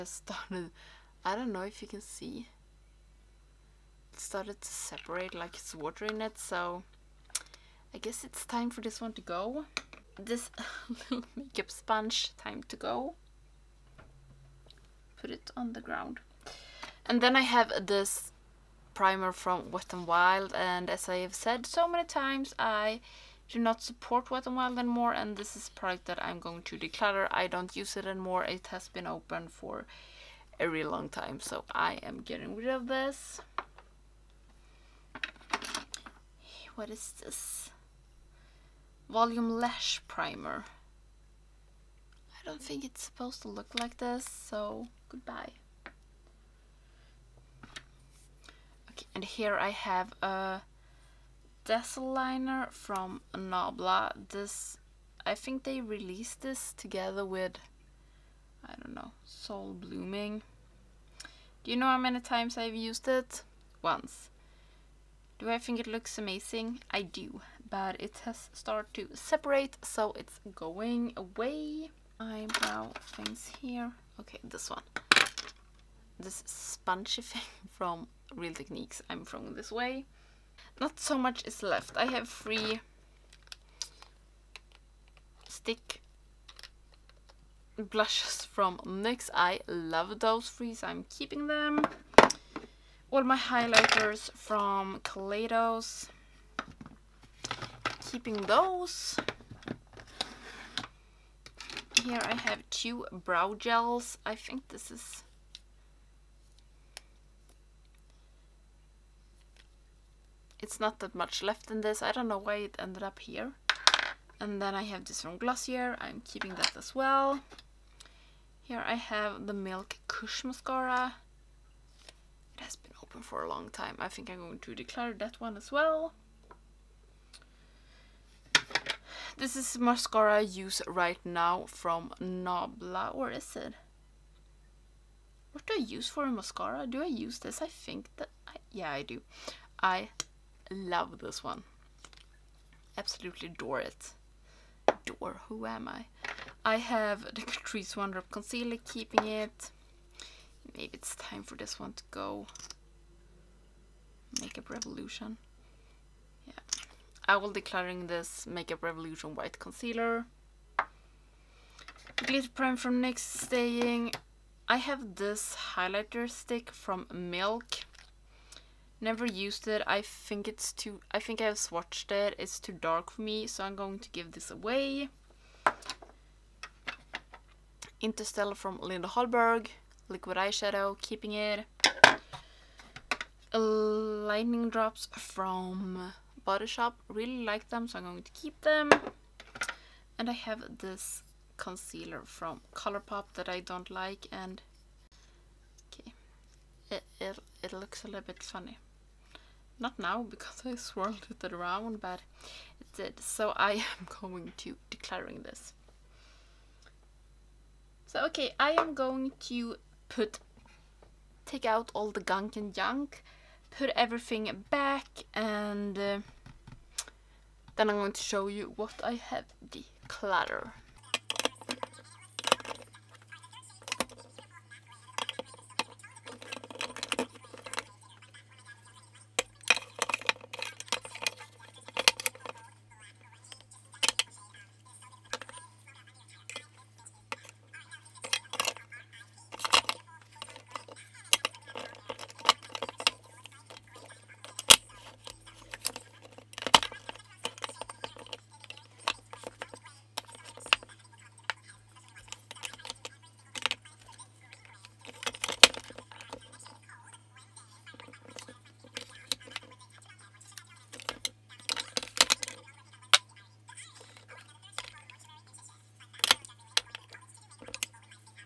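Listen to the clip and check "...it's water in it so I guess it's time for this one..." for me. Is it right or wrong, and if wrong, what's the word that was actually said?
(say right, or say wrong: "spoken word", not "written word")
right.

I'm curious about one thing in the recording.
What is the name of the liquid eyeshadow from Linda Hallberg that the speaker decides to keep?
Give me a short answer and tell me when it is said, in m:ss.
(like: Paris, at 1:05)
Interstellar, at 2:57.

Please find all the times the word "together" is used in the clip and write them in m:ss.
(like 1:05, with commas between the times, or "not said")
0:56.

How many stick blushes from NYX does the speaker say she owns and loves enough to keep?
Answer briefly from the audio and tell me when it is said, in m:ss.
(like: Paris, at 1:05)
3, at 1:22.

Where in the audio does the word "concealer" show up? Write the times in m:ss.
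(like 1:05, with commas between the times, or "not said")
2:28, 2:39, 3:11.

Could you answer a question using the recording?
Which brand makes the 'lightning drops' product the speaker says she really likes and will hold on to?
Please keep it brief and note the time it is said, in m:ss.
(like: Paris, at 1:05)
Body Shop, at 3:06.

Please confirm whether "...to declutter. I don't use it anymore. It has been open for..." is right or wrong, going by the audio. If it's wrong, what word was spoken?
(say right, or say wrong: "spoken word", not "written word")
right.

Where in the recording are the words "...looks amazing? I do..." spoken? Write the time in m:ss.
1:05.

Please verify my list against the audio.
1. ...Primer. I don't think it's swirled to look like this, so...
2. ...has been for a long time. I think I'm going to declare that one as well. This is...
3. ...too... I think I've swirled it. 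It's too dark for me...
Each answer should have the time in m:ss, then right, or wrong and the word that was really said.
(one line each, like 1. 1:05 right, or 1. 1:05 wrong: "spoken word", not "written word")
1. 0:40 wrong: "supposed", not "swirled"
2. 2:02 right
3. 2:50 wrong: "swatched", not "swirled".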